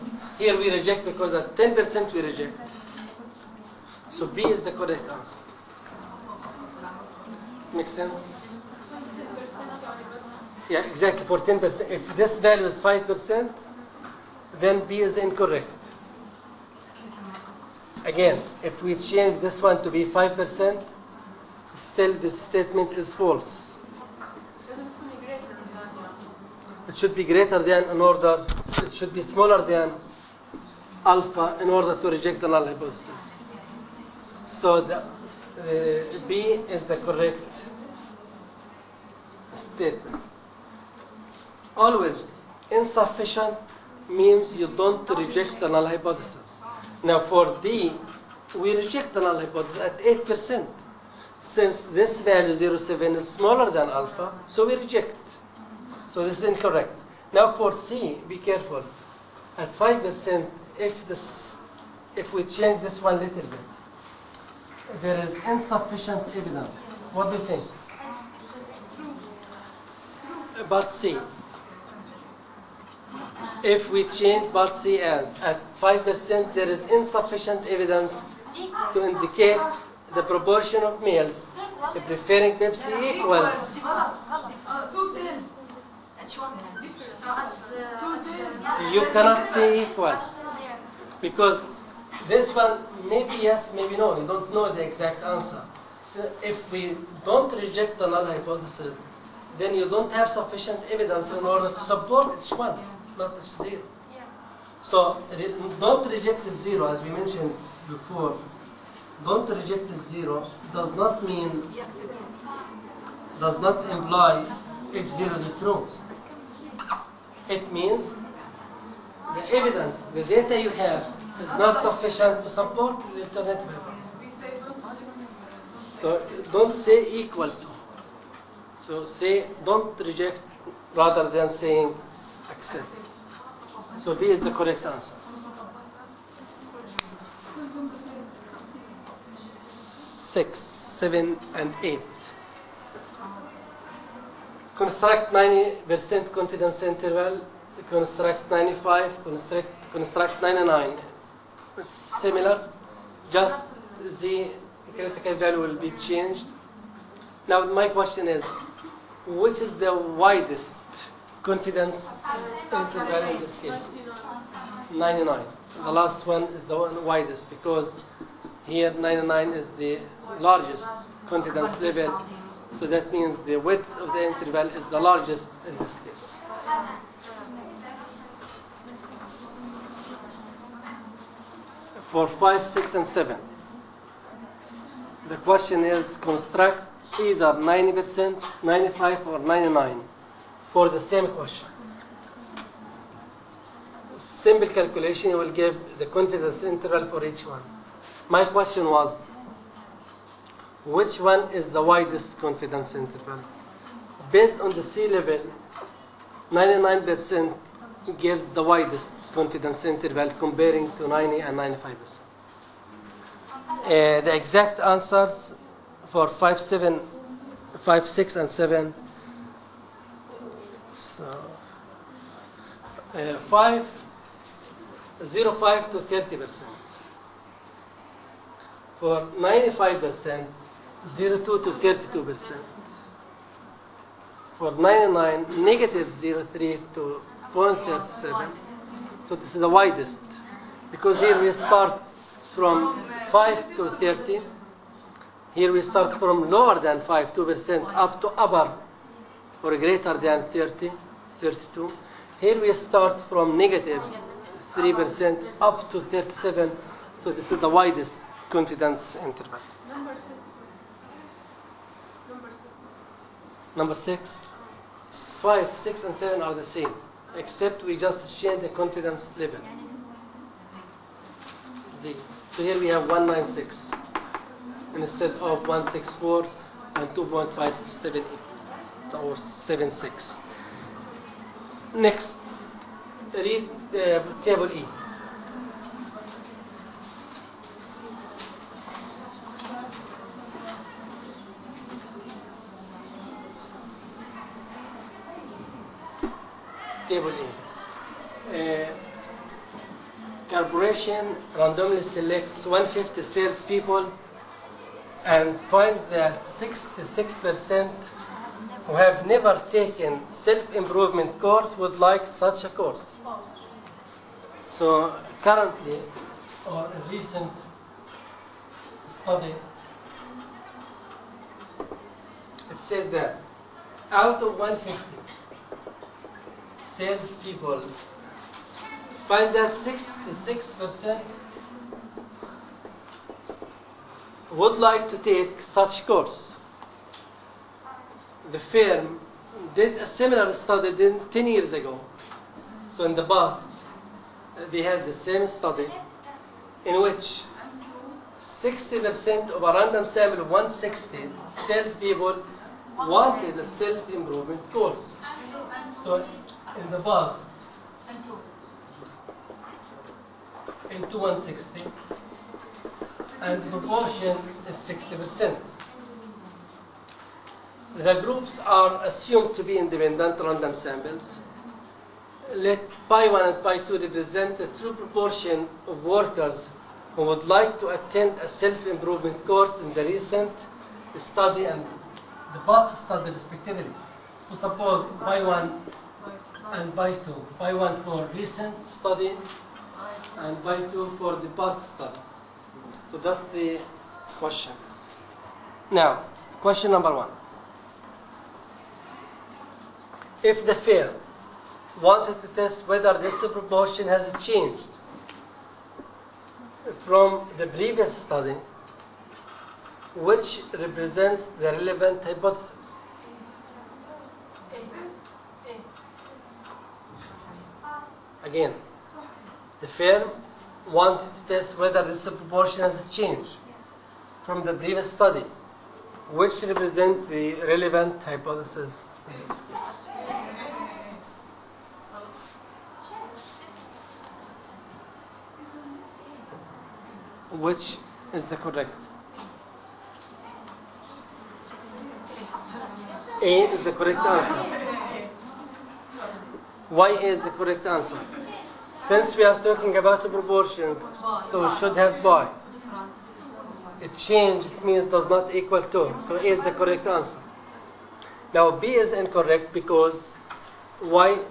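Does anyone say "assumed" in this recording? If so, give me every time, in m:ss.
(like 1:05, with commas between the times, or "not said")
6:09.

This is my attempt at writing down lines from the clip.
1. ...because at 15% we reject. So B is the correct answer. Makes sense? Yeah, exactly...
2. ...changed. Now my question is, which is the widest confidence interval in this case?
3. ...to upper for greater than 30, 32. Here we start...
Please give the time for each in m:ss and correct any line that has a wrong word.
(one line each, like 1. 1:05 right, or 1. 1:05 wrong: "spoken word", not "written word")
1. 0:01 wrong: "10", not "15"
2. 2:35 right
3. 4:08 right.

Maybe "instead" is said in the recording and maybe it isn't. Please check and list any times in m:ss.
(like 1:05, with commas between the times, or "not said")
4:34.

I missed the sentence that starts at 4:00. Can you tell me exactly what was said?
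Because here we start from 5 to 30.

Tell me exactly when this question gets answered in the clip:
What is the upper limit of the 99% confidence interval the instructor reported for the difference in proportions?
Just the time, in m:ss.
3:57.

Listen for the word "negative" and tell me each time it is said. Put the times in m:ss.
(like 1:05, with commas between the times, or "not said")
3:55, 4:13.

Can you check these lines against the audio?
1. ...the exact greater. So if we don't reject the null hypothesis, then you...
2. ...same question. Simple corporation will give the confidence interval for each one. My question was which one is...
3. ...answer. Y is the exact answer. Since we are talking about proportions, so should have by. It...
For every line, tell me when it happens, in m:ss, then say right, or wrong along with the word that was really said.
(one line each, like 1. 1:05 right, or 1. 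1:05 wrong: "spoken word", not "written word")
1. 1:34 wrong: "answer", not "greater"
2. 3:11 wrong: "calculation", not "corporation"
3. 7:24 wrong: "correct", not "exact".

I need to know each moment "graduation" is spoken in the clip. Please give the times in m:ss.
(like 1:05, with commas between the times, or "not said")
not said.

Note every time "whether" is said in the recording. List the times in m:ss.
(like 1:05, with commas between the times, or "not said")
6:42, 7:01.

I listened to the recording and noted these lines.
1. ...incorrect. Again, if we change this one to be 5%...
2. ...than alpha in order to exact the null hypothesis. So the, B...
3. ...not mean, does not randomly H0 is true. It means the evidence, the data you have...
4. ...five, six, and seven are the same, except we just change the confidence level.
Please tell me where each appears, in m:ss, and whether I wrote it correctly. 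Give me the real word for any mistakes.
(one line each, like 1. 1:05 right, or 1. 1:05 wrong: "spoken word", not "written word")
1. 0:15 right
2. 0:29 wrong: "reject", not "exact"
3. 1:50 wrong: "imply", not "randomly"
4. 4:25 right.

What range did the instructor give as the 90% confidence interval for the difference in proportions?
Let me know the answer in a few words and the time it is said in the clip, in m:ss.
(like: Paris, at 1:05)
5% to 30%, at 3:43.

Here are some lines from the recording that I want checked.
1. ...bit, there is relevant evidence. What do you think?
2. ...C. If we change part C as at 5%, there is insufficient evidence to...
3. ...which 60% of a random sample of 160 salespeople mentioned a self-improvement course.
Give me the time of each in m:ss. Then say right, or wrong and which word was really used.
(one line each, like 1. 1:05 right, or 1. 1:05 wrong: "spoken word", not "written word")
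1. 1:03 wrong: "insufficient", not "relevant"
2. 1:10 right
3. 5:47 wrong: "wanted", not "mentioned".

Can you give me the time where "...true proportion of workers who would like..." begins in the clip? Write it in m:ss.
6:14.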